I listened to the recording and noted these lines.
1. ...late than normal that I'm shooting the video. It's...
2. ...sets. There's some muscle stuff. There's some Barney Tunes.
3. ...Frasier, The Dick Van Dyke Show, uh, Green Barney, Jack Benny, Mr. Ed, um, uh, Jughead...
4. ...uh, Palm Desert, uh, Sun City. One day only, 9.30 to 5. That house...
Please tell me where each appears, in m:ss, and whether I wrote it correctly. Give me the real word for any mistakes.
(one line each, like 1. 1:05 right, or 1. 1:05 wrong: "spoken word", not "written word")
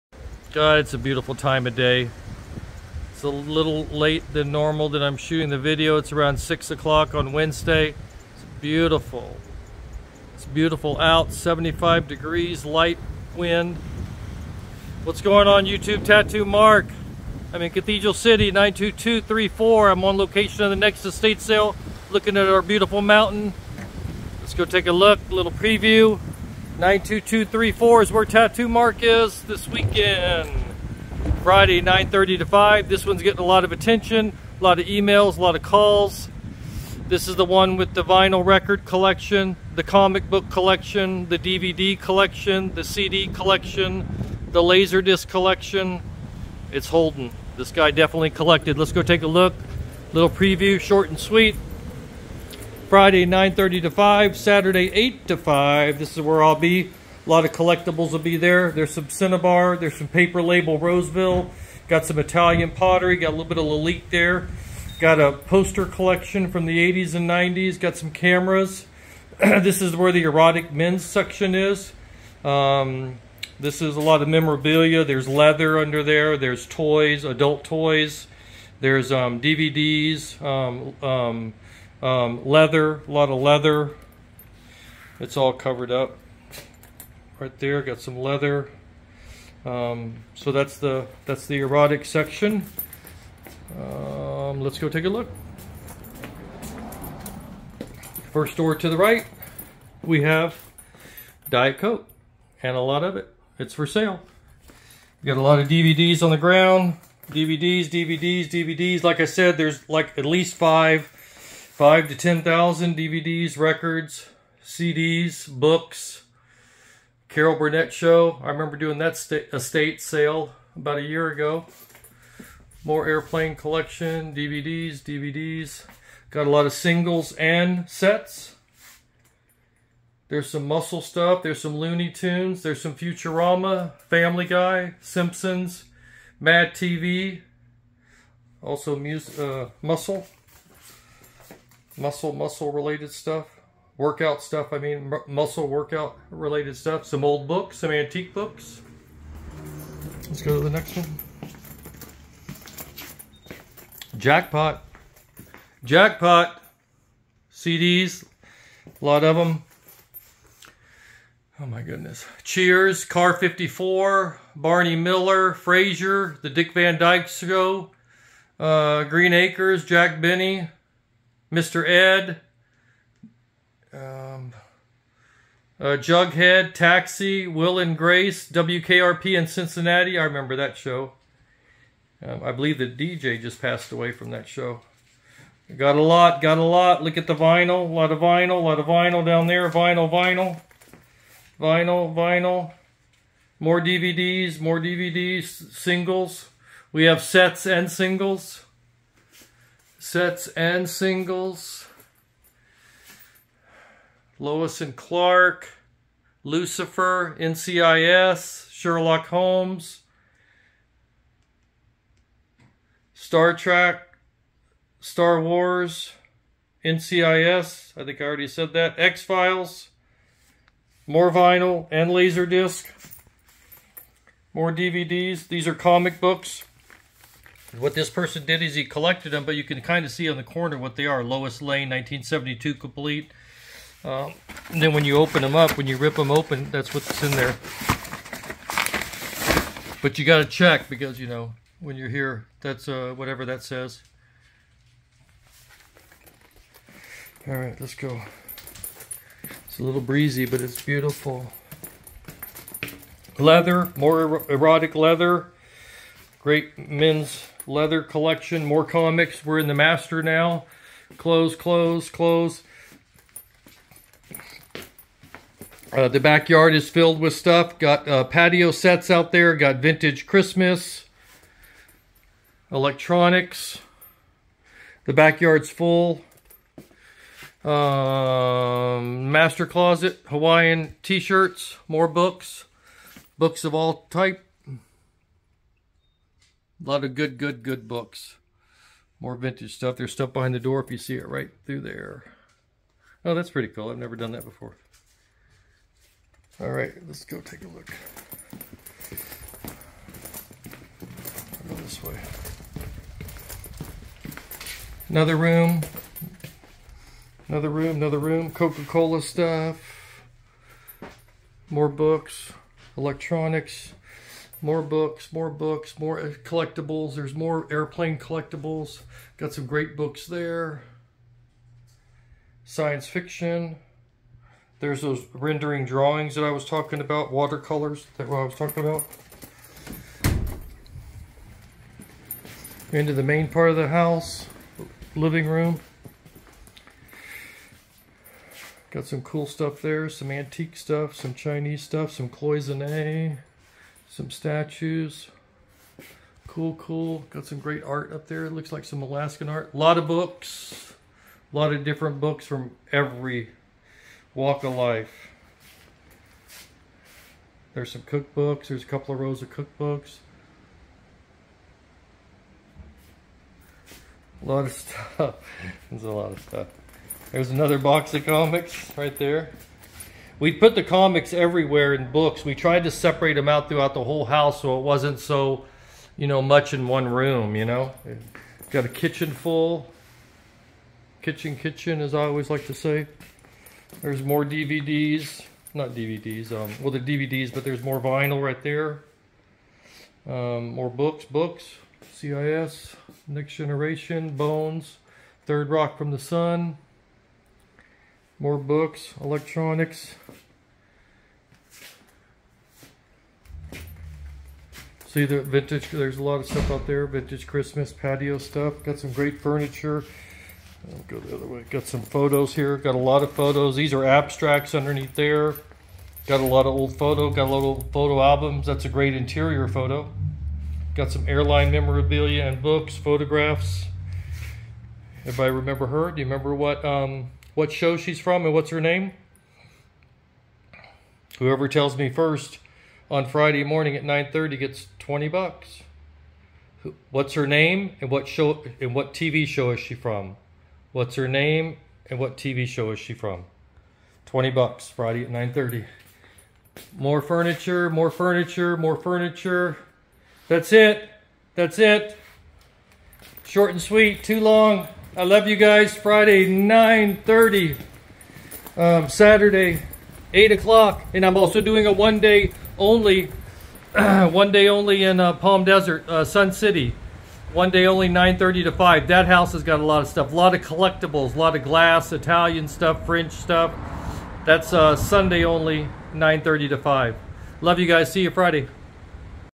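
1. 0:03 right
2. 2:07 wrong: "Looney", not "Barney"
3. 2:45 wrong: "Acres", not "Barney"
4. 7:45 right.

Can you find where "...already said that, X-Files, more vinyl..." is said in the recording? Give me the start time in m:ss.
3:38.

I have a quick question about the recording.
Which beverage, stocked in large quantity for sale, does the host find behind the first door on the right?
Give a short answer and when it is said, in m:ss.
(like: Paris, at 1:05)
Diet Coke, at 1:41.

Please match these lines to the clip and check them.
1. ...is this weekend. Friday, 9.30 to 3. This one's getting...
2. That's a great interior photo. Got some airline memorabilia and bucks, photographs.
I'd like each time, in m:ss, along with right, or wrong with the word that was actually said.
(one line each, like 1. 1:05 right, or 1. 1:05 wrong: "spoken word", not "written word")
1. 0:29 wrong: "5", not "3"
2. 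6:58 wrong: "books", not "bucks".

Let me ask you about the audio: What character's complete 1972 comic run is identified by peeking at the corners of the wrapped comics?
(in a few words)
Lois Lane.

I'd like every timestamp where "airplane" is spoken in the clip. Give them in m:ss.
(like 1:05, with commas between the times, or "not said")
2:03, 5:17.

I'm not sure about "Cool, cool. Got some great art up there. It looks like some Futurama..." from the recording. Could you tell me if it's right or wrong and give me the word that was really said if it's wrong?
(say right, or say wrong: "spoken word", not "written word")
wrong: "Alaskan", not "Futurama".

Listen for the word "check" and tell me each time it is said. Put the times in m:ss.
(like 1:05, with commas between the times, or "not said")
4:00.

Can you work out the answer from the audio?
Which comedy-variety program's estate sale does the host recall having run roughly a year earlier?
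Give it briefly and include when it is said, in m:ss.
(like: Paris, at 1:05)
Carol Burnett show, at 1:57.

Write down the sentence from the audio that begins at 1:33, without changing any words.
Um, let's go take a look.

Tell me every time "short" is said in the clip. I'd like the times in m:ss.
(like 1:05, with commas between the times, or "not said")
0:50, 7:33.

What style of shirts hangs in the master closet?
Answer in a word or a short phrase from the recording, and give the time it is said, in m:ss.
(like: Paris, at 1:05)
Hawaiian t-shirts, at 4:40.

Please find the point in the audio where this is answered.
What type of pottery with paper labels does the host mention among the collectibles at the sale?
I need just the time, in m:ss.
1:00.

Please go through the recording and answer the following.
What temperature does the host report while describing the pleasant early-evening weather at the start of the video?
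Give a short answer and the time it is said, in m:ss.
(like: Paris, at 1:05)
75 degrees, at 0:11.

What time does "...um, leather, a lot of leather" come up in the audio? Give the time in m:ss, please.
1:22.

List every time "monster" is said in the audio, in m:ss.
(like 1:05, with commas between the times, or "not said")
not said.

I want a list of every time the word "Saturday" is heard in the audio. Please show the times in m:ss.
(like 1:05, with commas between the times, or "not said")
0:54, 7:39.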